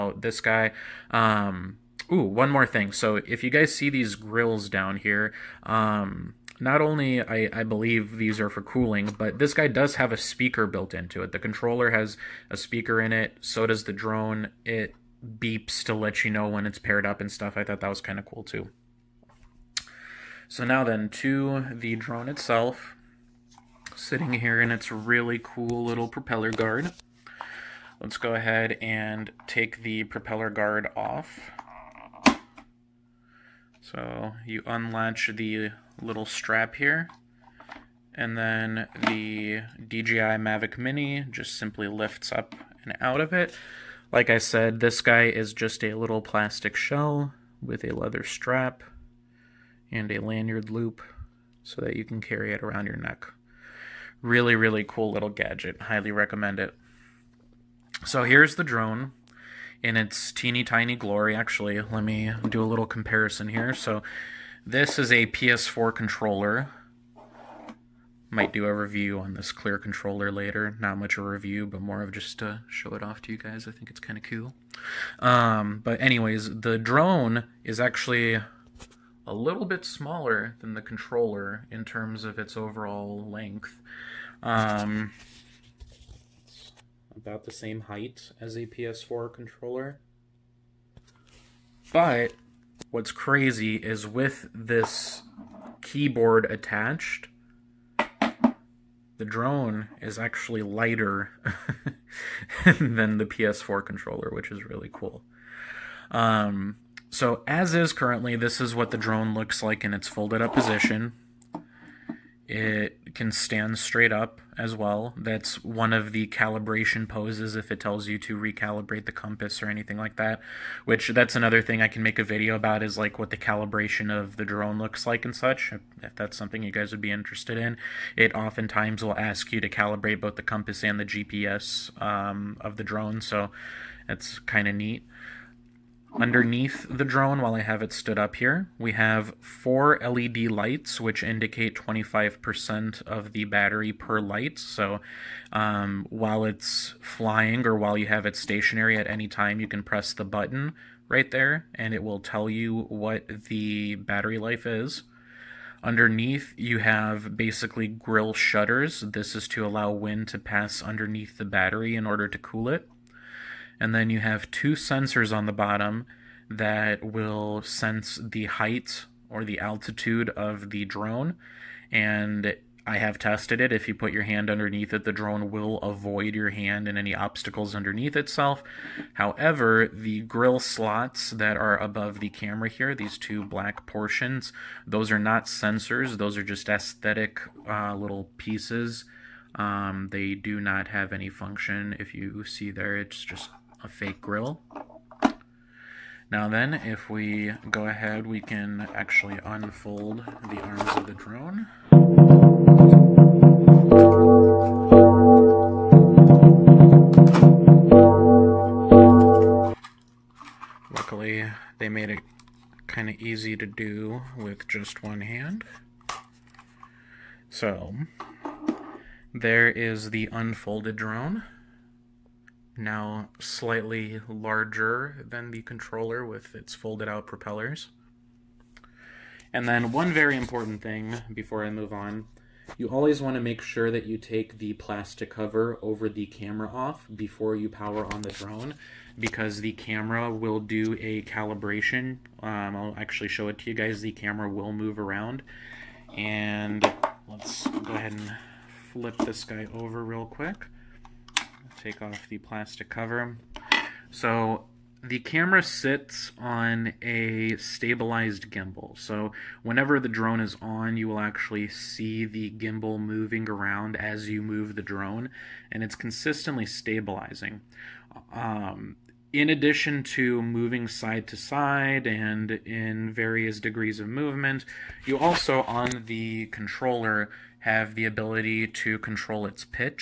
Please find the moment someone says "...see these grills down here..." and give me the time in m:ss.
0:03.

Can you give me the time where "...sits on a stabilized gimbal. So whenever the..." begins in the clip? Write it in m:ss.
4:15.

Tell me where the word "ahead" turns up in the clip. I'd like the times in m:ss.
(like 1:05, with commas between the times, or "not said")
0:28, 3:17, 4:07.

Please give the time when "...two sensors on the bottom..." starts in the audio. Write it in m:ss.
2:44.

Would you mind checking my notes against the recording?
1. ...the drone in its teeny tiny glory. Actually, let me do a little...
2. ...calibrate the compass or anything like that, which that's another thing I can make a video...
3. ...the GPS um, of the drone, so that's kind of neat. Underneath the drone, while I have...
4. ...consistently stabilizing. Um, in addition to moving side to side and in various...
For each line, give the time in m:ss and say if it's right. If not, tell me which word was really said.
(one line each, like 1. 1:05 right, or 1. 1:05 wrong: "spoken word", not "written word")
1. 0:58 right
2. 1:58 wrong: "recalibrate", not "calibrate"
3. 2:10 right
4. 4:25 right.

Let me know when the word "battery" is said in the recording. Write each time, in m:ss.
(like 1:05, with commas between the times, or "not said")
2:23, 2:33, 2:41.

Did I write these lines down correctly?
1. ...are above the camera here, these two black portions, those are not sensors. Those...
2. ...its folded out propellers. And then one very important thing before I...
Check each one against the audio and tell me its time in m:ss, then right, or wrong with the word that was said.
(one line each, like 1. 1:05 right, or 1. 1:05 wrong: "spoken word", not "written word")
1. 3:01 right
2. 3:46 right.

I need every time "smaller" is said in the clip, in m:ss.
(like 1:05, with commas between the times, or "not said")
1:19.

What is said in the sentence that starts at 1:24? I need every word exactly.
Um, about the same height as a PS4 controller.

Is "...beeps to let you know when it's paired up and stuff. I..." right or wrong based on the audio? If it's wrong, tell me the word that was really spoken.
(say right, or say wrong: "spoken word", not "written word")
right.